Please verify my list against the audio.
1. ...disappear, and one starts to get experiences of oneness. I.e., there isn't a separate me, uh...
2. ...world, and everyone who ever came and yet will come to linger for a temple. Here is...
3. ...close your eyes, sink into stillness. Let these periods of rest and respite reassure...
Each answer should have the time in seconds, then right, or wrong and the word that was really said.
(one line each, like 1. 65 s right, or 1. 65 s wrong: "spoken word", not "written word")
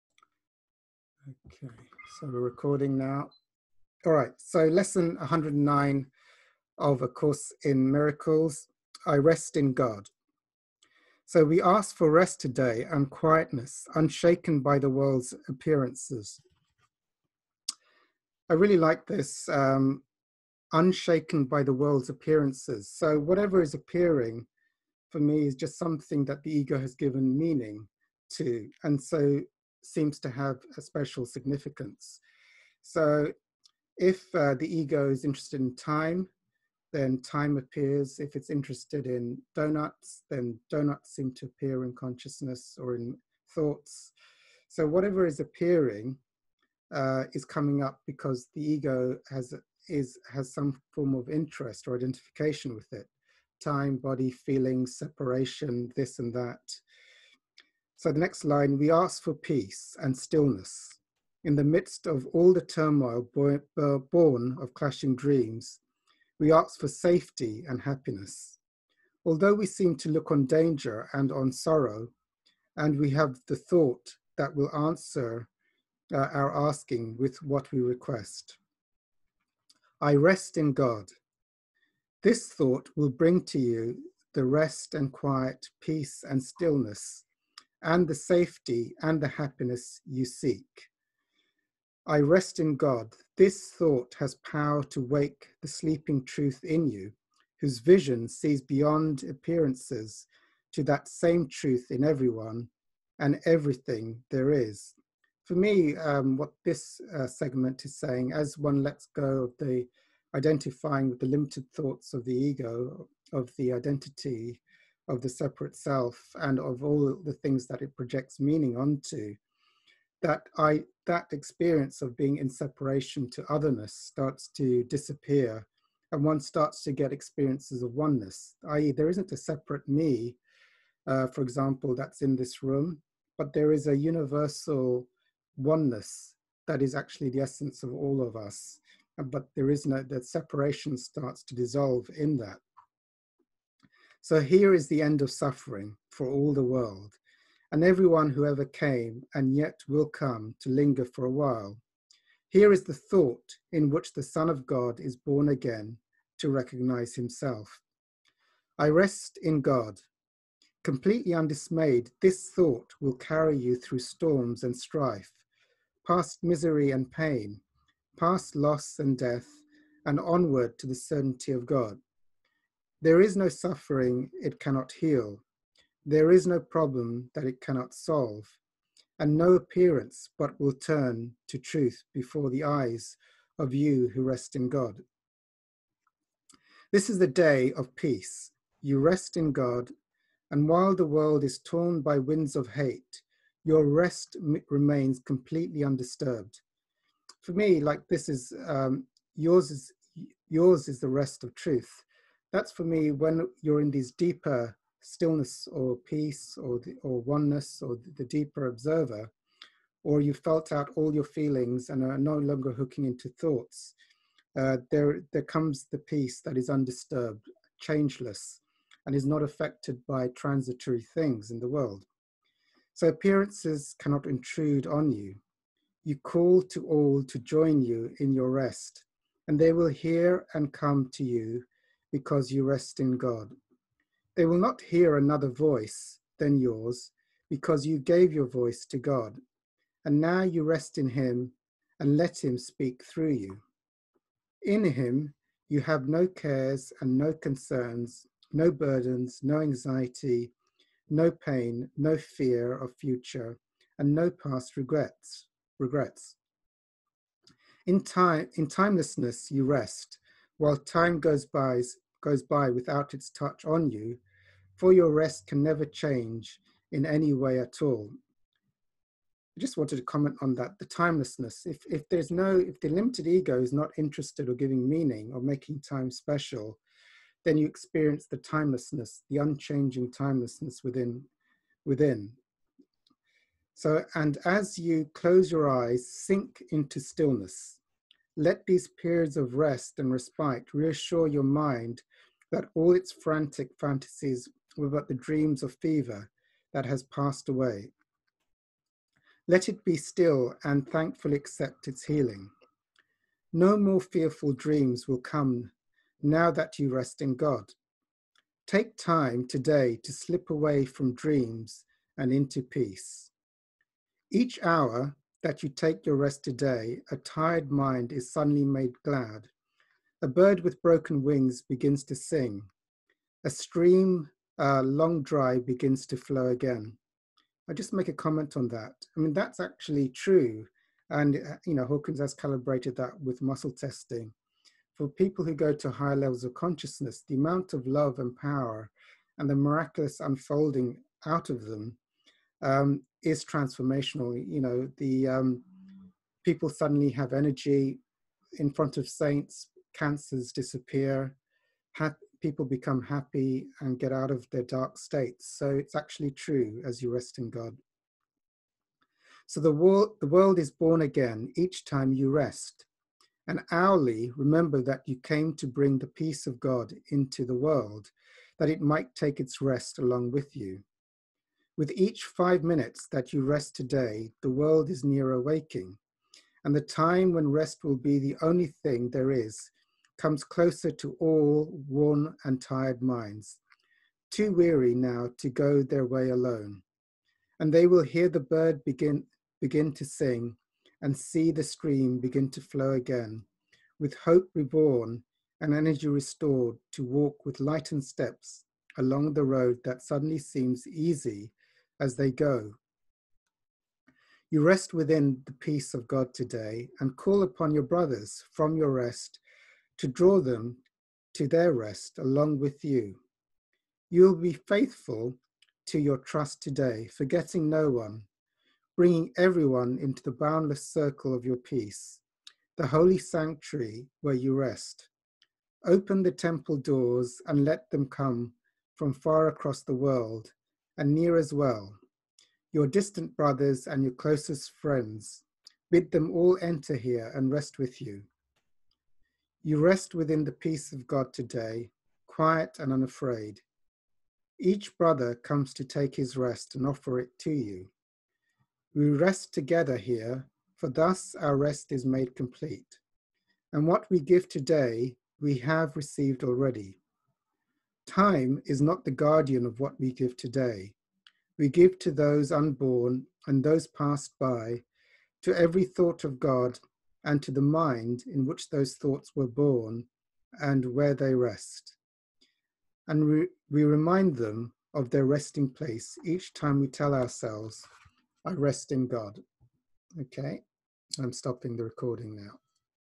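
1. 124 s right
2. 146 s wrong: "while", not "temple"
3. 285 s right.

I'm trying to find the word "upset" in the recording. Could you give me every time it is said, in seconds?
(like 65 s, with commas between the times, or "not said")
not said.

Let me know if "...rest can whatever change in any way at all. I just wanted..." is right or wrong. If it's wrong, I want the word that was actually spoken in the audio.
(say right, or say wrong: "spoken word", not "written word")
wrong: "never", not "whatever".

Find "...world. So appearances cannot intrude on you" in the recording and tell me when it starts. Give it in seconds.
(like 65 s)
221 s.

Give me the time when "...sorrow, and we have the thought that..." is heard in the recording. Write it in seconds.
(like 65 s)
71 s.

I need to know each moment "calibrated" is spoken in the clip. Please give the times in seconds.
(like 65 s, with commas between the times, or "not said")
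332 s.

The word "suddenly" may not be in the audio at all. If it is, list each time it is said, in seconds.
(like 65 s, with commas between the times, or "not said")
318 s, 346 s, 400 s.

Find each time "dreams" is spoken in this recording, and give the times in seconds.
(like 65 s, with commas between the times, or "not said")
65 s, 295 s, 304 s, 311 s.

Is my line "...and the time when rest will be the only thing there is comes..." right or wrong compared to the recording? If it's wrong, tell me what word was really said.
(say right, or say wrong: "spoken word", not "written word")
right.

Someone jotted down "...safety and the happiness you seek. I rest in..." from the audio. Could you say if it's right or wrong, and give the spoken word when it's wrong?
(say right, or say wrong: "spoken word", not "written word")
right.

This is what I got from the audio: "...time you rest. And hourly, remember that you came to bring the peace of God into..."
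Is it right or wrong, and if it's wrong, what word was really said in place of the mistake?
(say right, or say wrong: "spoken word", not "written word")
right.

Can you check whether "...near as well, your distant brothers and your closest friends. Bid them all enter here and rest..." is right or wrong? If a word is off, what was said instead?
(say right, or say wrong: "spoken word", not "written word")
right.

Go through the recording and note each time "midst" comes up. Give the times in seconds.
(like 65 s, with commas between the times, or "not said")
61 s.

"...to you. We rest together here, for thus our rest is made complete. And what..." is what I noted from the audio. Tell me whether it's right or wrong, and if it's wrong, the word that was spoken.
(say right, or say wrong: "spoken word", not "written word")
right.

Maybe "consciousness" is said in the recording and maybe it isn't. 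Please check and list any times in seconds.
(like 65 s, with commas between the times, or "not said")
41 s, 336 s.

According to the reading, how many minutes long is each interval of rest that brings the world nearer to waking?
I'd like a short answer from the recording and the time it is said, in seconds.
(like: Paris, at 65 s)
5, at 372 s.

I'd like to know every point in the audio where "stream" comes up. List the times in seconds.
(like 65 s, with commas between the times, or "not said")
323 s, 391 s.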